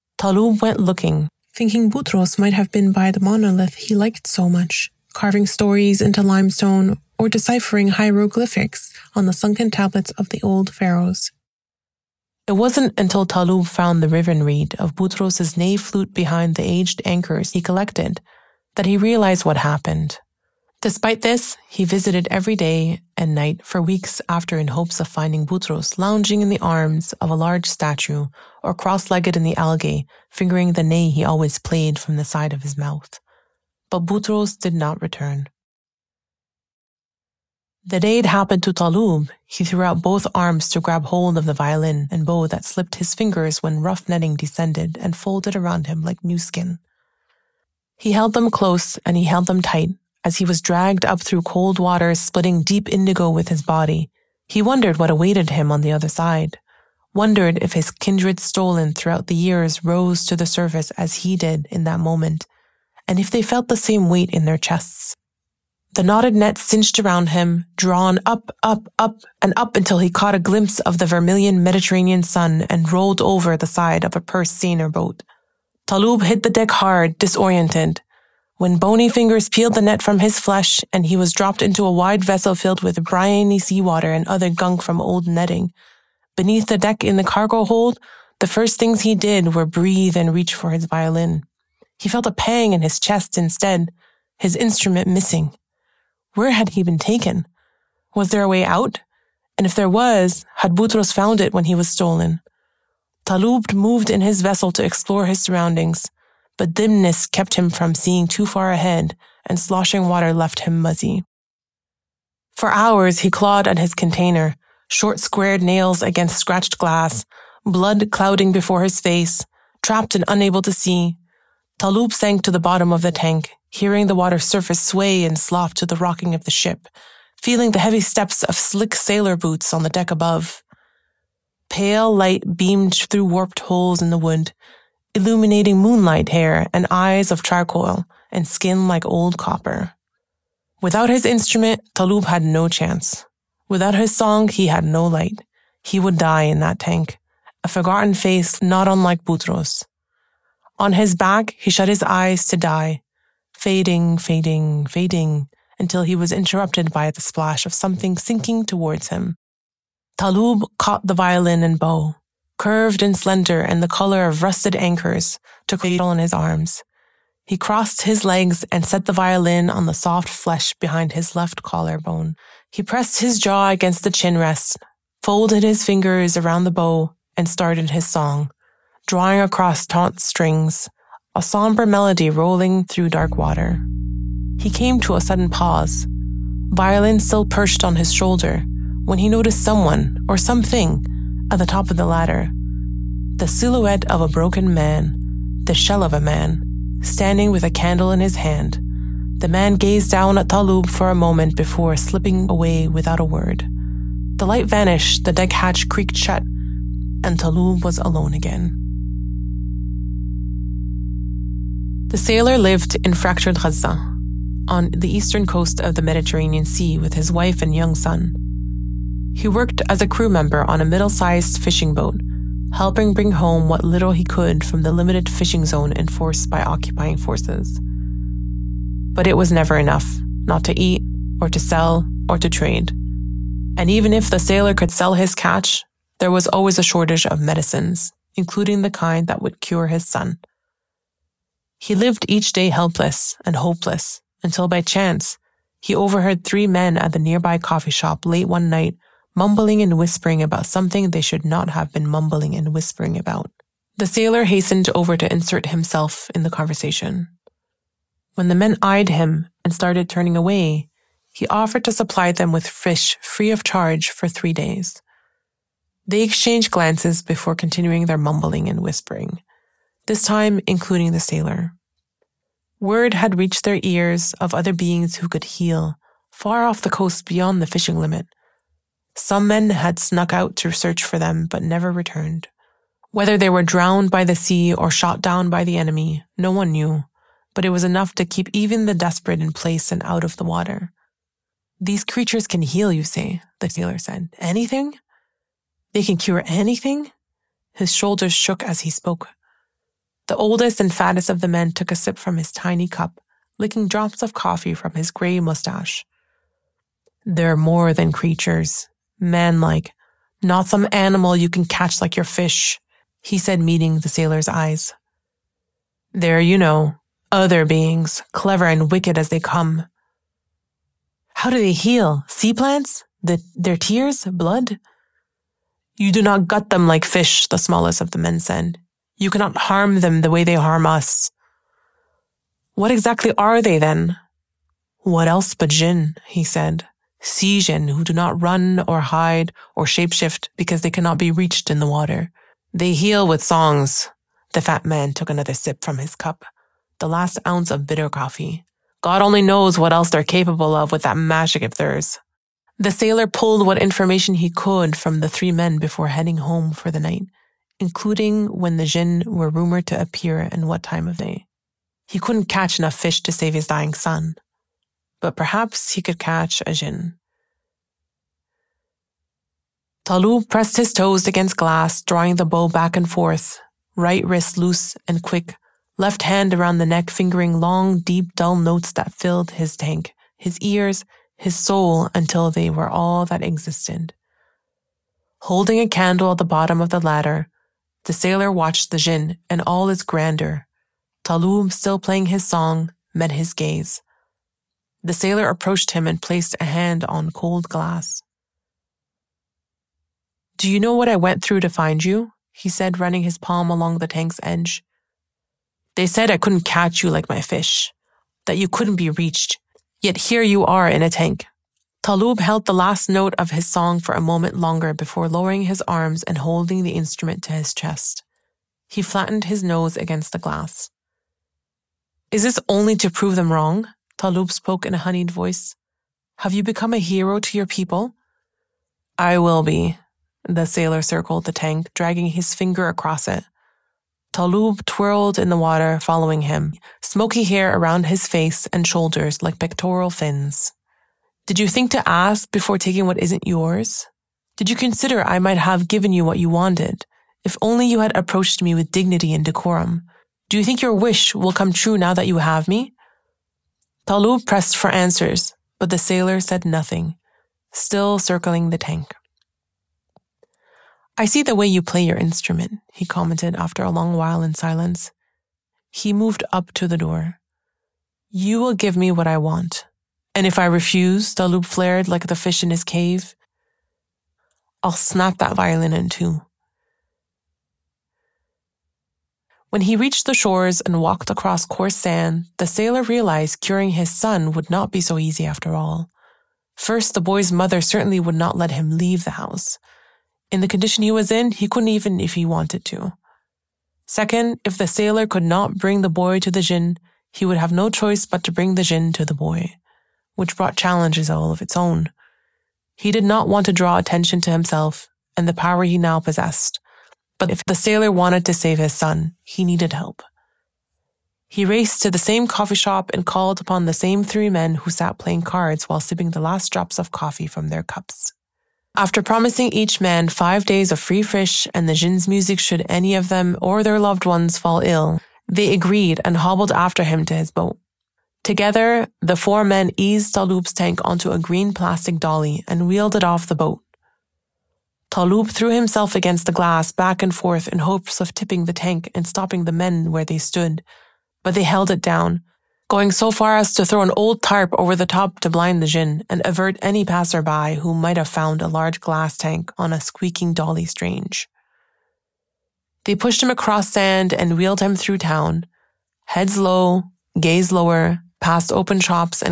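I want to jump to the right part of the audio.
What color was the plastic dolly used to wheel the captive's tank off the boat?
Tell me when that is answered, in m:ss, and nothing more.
8:51.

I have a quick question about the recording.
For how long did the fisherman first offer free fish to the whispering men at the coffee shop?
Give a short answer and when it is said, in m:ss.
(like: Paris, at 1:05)
3 days, at 4:24.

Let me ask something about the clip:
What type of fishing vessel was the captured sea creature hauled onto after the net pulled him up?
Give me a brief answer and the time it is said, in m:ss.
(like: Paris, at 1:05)
purse seiner, at 1:14.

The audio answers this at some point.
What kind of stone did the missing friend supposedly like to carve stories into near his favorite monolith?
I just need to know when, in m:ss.
0:06.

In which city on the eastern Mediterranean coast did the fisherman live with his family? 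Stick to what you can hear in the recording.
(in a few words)
Gaza.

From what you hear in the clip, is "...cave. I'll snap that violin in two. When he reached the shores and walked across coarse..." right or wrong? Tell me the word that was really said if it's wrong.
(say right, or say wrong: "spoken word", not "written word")
right.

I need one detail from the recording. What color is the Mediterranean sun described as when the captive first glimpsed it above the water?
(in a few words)
vermilion.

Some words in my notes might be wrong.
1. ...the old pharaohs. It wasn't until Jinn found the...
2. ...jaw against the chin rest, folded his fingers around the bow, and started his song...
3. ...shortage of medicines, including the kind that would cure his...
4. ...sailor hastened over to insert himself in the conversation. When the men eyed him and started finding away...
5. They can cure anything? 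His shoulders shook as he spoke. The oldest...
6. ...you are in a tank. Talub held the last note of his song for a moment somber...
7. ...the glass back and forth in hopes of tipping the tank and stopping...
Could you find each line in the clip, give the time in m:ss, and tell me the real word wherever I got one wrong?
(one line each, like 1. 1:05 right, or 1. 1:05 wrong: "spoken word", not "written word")
1. 0:10 wrong: "Talub", not "Jinn"
2. 2:53 right
3. 3:56 right
4. 4:14 wrong: "turning", not "finding"
5. 4:55 right
6. 6:50 wrong: "longer", not "somber"
7. 8:56 right.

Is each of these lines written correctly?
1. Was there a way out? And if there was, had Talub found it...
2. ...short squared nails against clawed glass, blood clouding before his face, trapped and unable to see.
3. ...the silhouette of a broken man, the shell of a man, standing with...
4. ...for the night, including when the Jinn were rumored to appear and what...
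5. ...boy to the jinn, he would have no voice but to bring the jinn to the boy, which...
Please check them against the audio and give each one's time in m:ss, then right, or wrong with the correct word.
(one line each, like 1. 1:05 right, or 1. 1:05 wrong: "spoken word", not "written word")
1. 1:38 wrong: "Butros", not "Talub"
2. 1:54 wrong: "scratched", not "clawed"
3. 3:13 right
4. 5:56 right
5. 8:16 wrong: "choice", not "voice".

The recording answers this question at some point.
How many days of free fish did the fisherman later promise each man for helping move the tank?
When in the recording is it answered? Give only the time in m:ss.
8:40.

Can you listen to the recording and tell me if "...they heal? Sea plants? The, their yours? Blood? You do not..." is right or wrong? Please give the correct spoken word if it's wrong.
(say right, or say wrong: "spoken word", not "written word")
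wrong: "tears", not "yours".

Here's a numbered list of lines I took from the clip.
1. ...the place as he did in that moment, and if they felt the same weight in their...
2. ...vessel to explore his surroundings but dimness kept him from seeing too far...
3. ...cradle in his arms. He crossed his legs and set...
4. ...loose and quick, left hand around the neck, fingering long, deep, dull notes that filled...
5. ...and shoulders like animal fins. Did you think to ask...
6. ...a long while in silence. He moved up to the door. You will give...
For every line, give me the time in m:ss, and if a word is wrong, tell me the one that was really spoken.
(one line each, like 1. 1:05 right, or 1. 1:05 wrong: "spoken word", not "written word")
1. 1:00 wrong: "surface", not "place"
2. 1:44 right
3. 2:45 right
4. 6:14 right
5. 7:18 wrong: "pectoral", not "animal"
6. 7:43 right.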